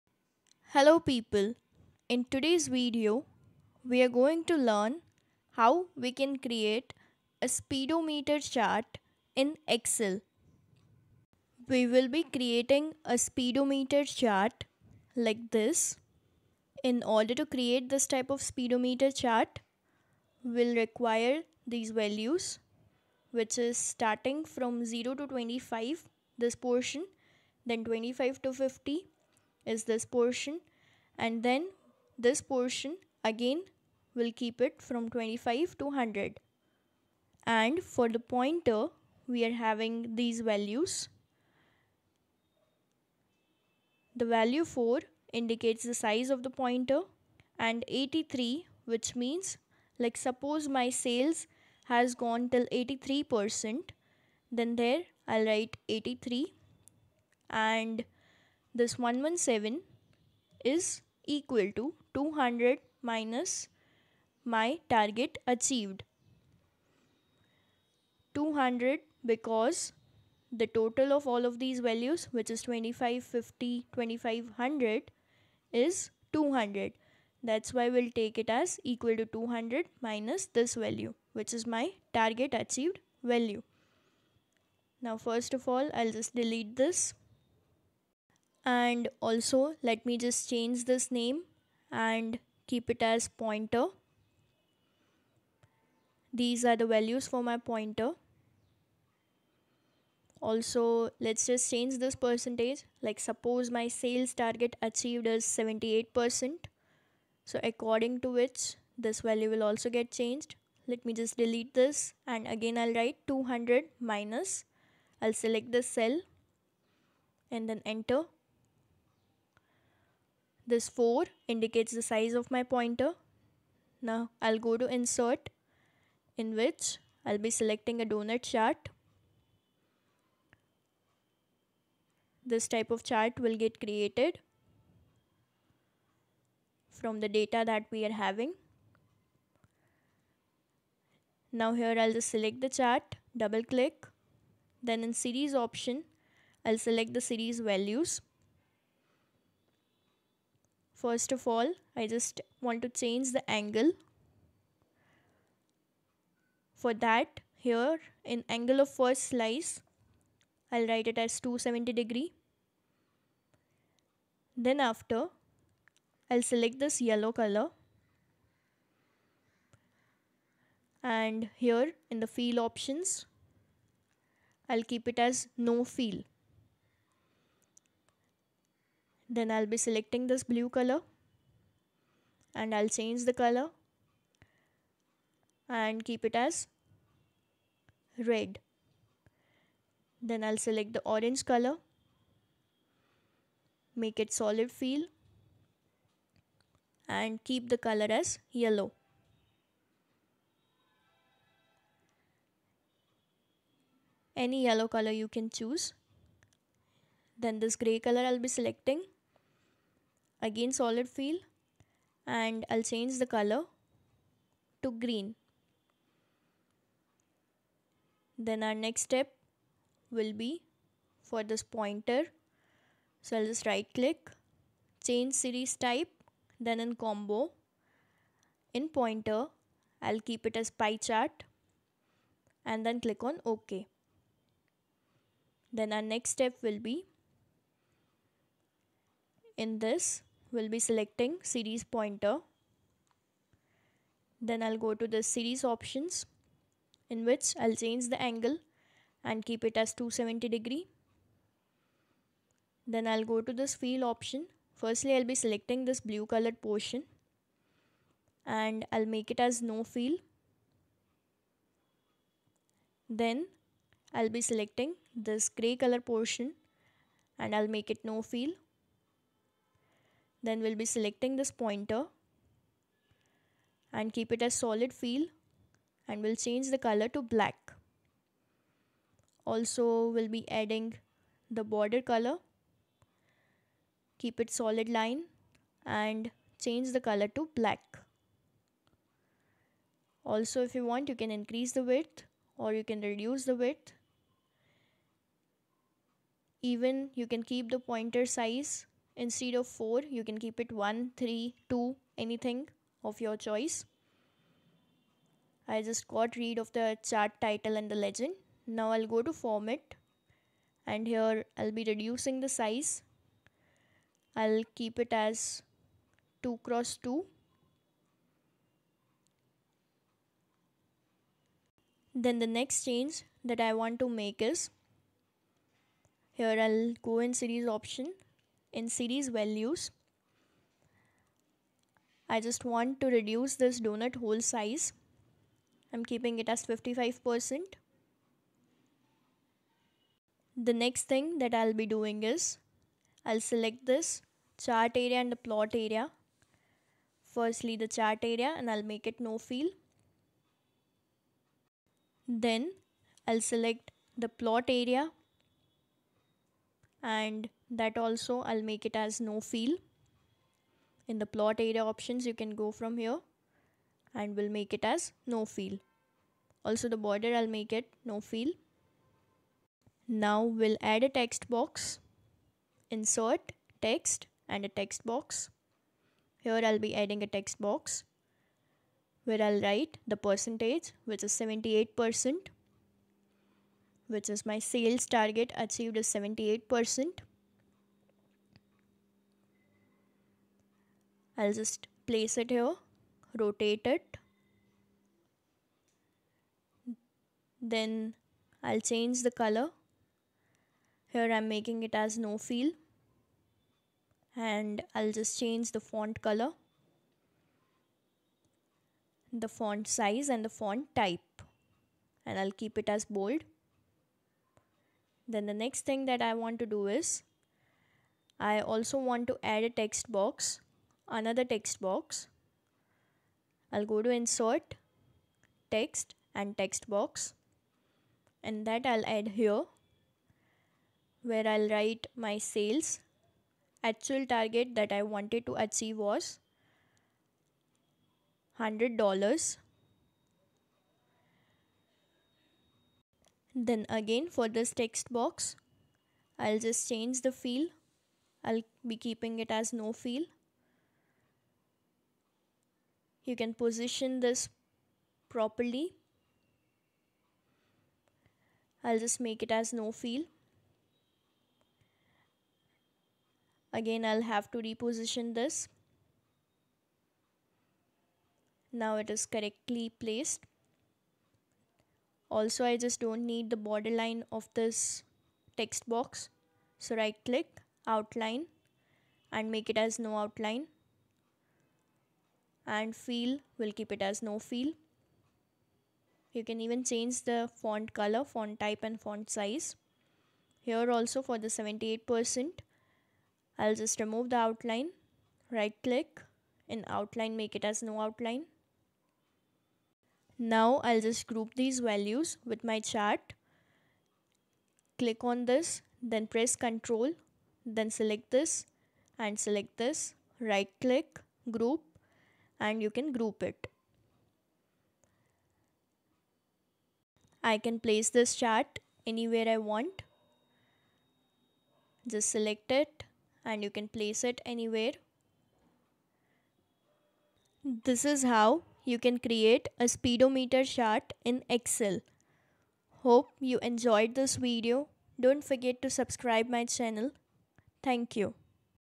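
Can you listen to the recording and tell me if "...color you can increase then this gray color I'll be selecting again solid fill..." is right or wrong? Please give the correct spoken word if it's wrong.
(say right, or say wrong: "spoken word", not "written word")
wrong: "choose", not "increase".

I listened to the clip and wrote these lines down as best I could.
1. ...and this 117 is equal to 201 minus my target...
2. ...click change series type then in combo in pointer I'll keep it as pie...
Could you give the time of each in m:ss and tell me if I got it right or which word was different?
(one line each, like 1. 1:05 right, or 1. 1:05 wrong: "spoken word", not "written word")
1. 0:57 wrong: "200", not "201"
2. 3:43 right.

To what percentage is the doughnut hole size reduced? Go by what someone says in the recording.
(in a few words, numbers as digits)
55%.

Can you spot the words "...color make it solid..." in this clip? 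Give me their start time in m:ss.
3:11.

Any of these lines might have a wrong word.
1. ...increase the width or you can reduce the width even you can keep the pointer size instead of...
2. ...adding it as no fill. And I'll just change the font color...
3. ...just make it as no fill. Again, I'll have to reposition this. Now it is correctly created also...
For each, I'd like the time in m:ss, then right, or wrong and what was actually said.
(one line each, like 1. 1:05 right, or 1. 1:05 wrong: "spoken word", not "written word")
1. 4:51 right
2. 6:41 wrong: "making", not "adding"
3. 7:38 wrong: "placed", not "created".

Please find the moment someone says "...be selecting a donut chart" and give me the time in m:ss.
2:07.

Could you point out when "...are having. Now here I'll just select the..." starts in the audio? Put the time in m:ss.
2:18.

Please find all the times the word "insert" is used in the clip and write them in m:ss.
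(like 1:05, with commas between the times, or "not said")
2:04, 6:12, 7:04.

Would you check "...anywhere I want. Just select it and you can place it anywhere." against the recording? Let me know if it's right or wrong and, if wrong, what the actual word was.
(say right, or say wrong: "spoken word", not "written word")
right.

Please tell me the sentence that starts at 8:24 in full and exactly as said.
Click on this, then press Ctrl, then select this and select this, right click, group and you can group it.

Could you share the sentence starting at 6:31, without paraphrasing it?
I'll just place it here, rotate it.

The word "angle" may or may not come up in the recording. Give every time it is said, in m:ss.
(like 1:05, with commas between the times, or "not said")
2:33, 2:38, 4:08.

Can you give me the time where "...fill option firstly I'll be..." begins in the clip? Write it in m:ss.
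4:13.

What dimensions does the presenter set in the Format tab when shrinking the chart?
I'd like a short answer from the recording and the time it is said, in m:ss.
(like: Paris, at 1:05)
2 x 2, at 5:16.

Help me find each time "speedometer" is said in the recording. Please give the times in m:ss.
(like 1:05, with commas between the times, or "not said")
0:07, 0:13, 0:18, 8:49.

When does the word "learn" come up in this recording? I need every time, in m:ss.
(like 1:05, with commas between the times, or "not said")
0:04.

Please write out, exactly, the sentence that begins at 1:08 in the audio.
200 because the total of all of these values which is 25, 50, 2500 is 200.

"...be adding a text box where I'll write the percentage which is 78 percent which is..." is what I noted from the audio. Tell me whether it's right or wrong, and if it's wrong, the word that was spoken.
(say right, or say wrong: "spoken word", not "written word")
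right.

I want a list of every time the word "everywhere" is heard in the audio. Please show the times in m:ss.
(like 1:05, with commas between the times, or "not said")
not said.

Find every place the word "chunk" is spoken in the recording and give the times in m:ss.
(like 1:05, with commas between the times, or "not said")
not said.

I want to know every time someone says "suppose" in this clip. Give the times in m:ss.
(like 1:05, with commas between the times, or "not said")
0:50, 1:43.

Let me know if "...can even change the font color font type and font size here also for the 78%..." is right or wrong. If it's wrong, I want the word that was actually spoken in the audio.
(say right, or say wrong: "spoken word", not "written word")
right.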